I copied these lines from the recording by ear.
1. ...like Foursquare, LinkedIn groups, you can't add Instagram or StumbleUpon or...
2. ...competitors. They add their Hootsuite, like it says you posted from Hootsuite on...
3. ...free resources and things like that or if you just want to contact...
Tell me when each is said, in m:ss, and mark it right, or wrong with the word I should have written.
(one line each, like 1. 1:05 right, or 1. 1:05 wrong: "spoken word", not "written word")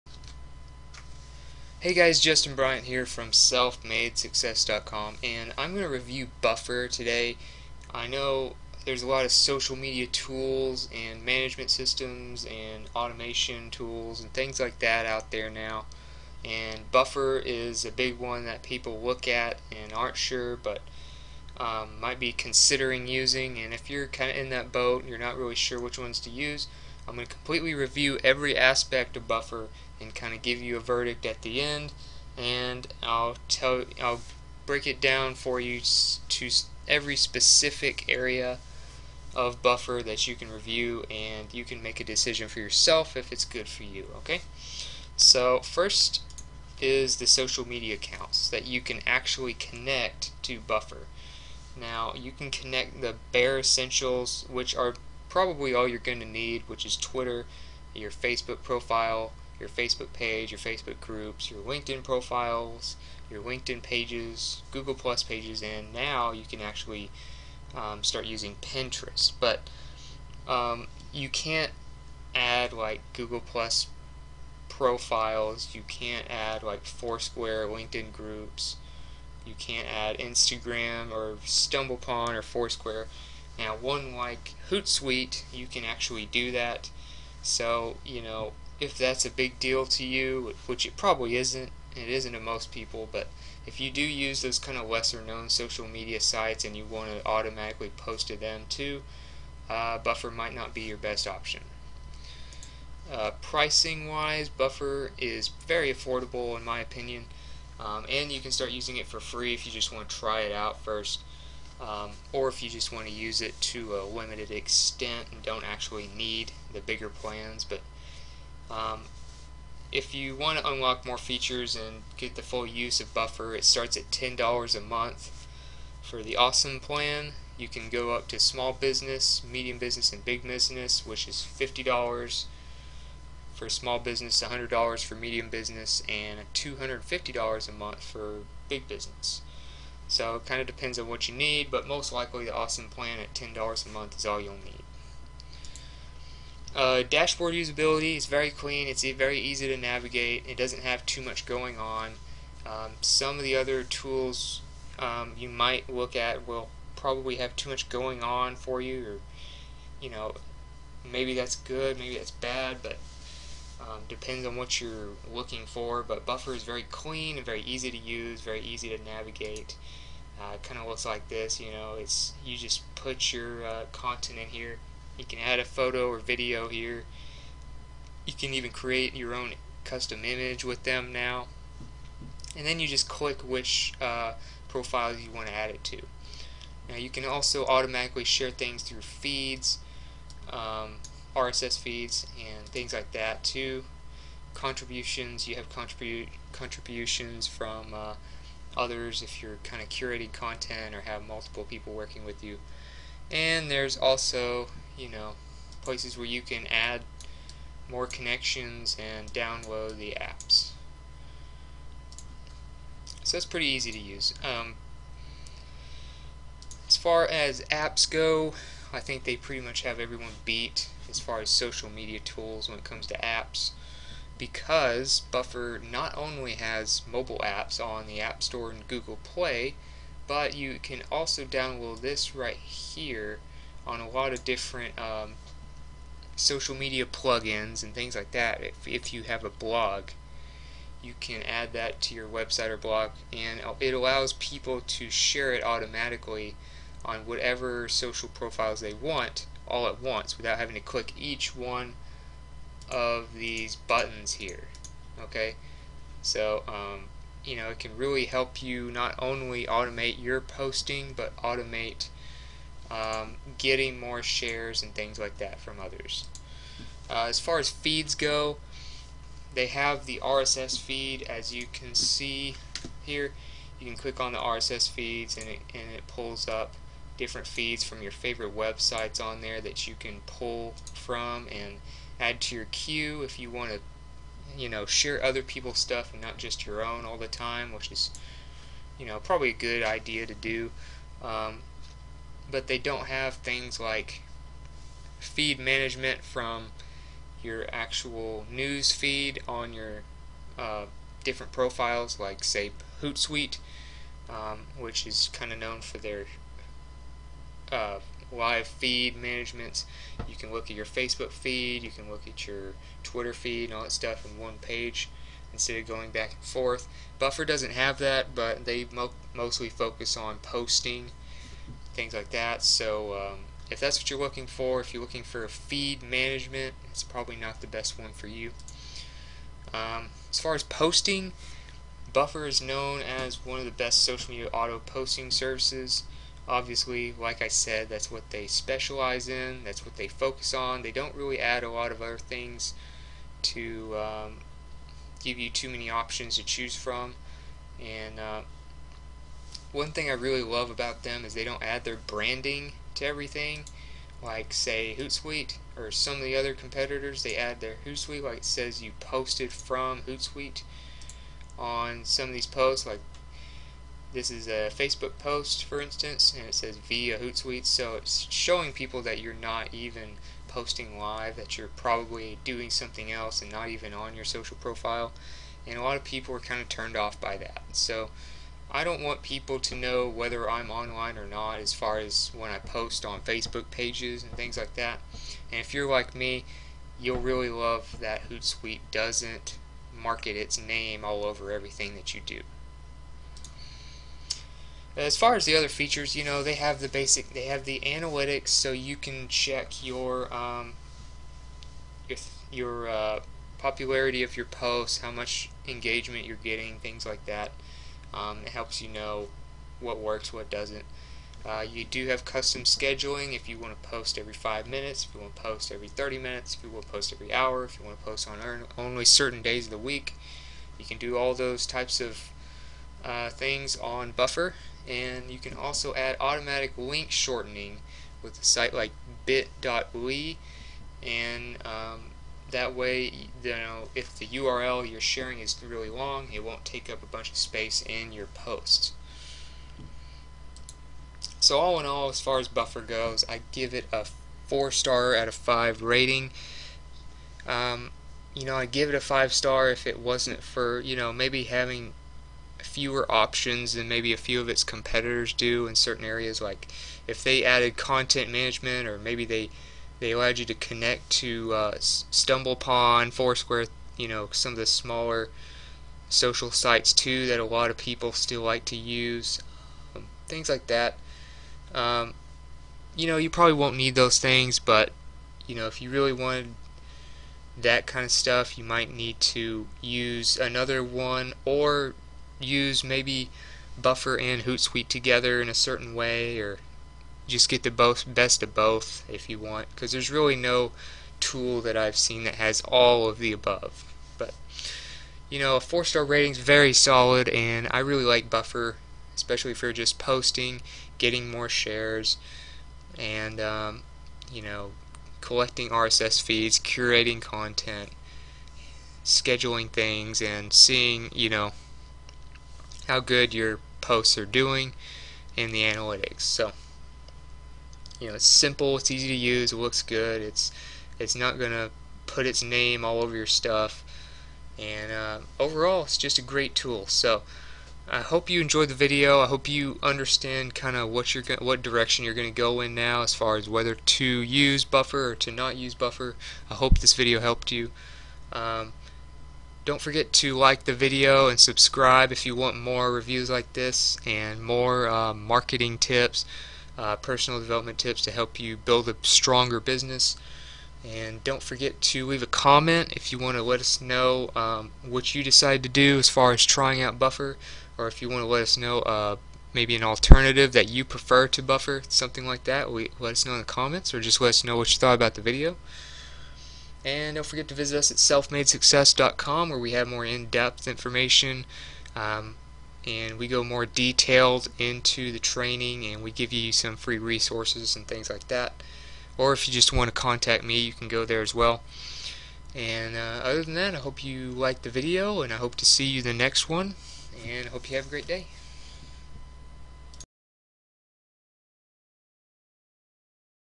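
1. 1:16 right
2. 5:56 right
3. 9:36 right.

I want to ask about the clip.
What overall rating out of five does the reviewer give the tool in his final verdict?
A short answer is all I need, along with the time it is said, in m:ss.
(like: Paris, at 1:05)
4 stars, at 7:24.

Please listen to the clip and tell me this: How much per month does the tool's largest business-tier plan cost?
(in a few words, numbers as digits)
$250.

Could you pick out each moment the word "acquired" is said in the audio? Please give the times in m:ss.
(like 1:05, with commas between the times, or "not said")
not said.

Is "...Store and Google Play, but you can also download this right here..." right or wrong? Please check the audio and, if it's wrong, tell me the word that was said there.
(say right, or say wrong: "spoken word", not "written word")
right.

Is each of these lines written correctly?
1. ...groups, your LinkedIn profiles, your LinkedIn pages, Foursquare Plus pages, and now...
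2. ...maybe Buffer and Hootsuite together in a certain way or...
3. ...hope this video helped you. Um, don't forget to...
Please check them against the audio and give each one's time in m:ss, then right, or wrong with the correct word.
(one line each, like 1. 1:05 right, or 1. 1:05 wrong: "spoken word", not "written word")
1. 1:00 wrong: "Google", not "Foursquare"
2. 8:02 right
3. 8:56 right.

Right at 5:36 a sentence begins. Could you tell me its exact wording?
Obviously, like I said, that's what they specialize in, that's what they focus on.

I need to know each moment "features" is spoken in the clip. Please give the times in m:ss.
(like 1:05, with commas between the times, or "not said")
2:01, 6:35.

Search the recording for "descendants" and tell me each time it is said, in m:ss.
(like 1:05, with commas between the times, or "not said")
not said.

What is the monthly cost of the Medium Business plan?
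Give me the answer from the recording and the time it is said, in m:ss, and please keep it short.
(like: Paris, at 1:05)
$100, at 2:14.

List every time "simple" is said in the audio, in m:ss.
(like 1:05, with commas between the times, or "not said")
8:38.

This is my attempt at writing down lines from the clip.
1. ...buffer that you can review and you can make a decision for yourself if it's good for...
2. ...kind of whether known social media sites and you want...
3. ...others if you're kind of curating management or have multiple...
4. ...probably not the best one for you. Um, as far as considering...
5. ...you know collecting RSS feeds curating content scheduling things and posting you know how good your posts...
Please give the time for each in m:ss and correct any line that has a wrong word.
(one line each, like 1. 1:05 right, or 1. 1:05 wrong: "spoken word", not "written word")
1. 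0:39 right
2. 1:34 wrong: "lesser", not "whether"
3. 3:18 wrong: "content", not "management"
4. 5:27 wrong: "posting", not "considering"
5. 8:24 wrong: "seeing", not "posting".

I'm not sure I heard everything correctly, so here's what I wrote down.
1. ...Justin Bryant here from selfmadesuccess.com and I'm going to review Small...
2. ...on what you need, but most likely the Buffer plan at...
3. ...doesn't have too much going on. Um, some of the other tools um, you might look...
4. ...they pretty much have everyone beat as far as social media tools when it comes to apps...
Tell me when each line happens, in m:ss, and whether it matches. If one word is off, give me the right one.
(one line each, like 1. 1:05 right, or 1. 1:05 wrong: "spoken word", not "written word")
1. 0:02 wrong: "Buffer", not "Small"
2. 2:20 wrong: "Awesome", not "Buffer"
3. 2:30 right
4. 3:39 right.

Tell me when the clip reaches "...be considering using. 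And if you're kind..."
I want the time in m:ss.
0:22.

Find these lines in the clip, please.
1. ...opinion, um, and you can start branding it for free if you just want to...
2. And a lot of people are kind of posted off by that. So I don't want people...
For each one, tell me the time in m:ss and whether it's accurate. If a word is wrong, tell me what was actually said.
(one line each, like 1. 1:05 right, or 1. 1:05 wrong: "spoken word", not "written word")
1. 1:46 wrong: "using", not "branding"
2. 6:15 wrong: "turned", not "posted".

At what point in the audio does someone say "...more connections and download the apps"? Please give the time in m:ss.
3:27.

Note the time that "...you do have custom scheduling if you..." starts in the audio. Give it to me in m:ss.
6:51.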